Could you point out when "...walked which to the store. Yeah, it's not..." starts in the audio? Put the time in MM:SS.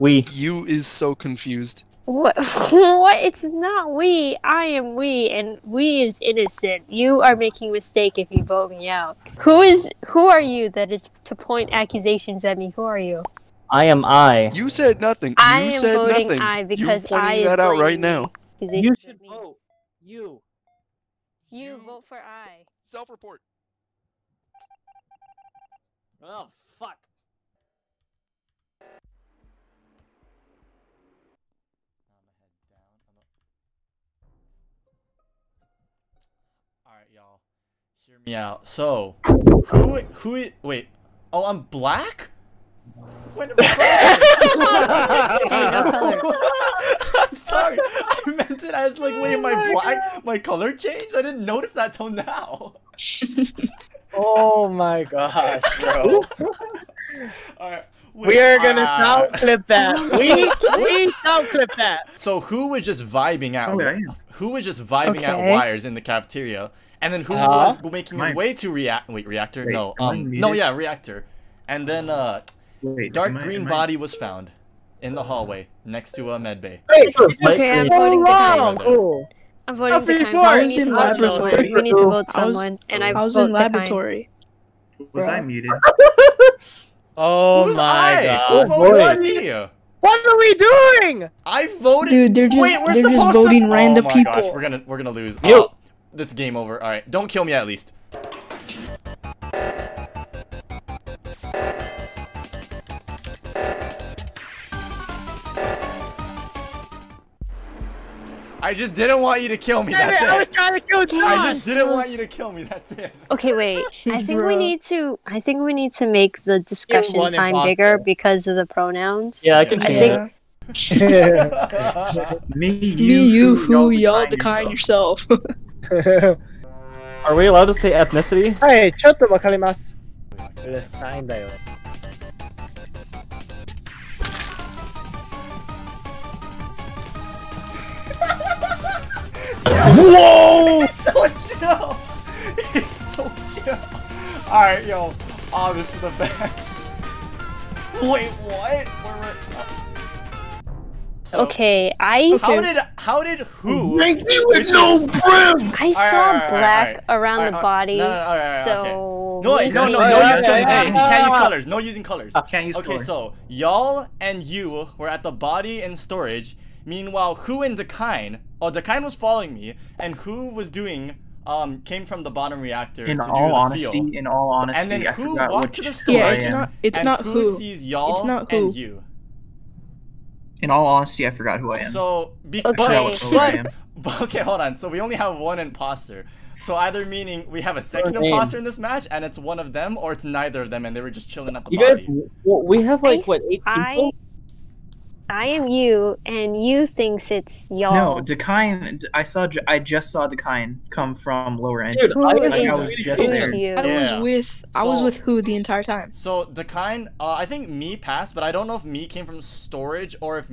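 02:55.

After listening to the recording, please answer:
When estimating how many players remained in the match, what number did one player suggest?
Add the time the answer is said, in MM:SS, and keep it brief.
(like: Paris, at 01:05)
8, at 03:13.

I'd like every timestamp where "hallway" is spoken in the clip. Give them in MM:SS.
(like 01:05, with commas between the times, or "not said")
01:15.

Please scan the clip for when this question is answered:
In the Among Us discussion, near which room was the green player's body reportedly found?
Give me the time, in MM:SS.
01:16.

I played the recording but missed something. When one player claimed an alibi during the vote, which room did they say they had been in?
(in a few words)
Laboratory.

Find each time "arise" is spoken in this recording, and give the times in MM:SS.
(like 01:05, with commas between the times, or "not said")
not said.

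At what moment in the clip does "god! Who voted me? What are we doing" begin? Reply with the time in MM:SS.
01:28.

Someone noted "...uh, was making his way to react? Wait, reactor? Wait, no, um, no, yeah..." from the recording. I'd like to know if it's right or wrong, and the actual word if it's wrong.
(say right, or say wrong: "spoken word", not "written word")
right.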